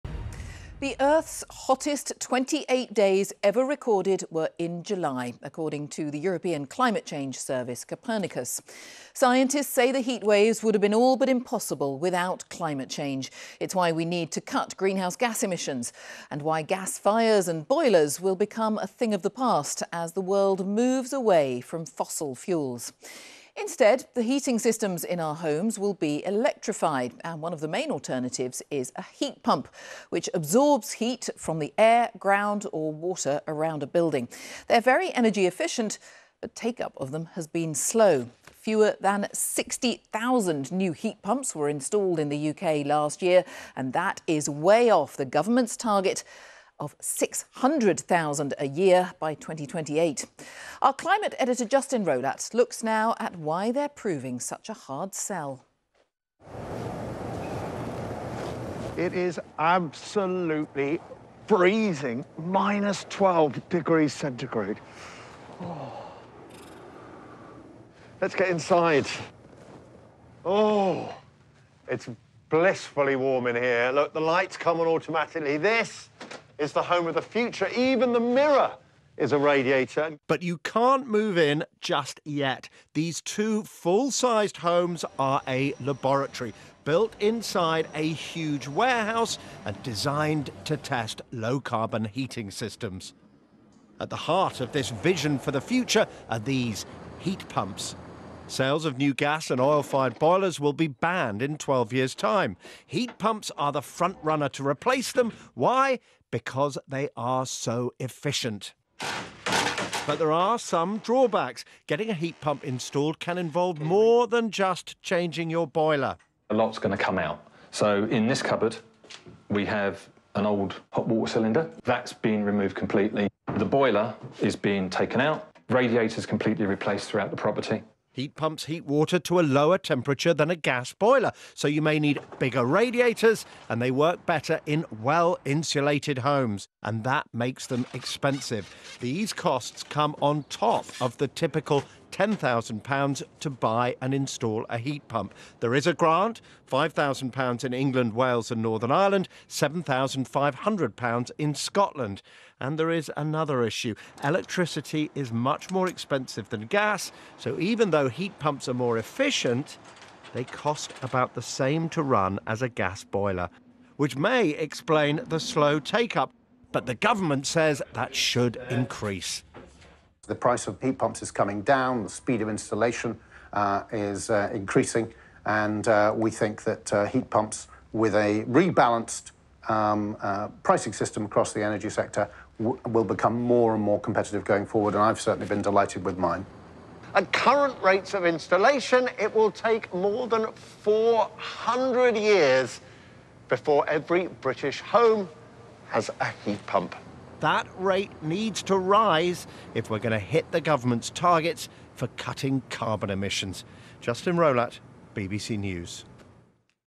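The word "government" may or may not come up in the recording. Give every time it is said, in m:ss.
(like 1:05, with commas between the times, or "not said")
0:45, 2:46, 3:20.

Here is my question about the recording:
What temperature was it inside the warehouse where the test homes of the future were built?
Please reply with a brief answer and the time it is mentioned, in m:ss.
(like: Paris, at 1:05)
-12°C, at 1:02.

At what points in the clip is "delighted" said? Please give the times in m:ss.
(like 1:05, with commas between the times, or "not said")
3:05.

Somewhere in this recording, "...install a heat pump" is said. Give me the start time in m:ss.
2:24.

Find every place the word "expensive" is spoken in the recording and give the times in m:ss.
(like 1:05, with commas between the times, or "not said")
2:17, 2:35.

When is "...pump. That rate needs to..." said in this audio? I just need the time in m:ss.
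3:16.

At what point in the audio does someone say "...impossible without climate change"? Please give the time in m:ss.
0:11.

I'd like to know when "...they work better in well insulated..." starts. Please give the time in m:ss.
2:13.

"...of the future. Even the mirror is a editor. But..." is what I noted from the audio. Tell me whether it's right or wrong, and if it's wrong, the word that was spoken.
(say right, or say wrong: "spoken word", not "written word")
wrong: "radiator", not "editor".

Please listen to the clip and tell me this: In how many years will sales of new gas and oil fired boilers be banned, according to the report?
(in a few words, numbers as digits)
12 years.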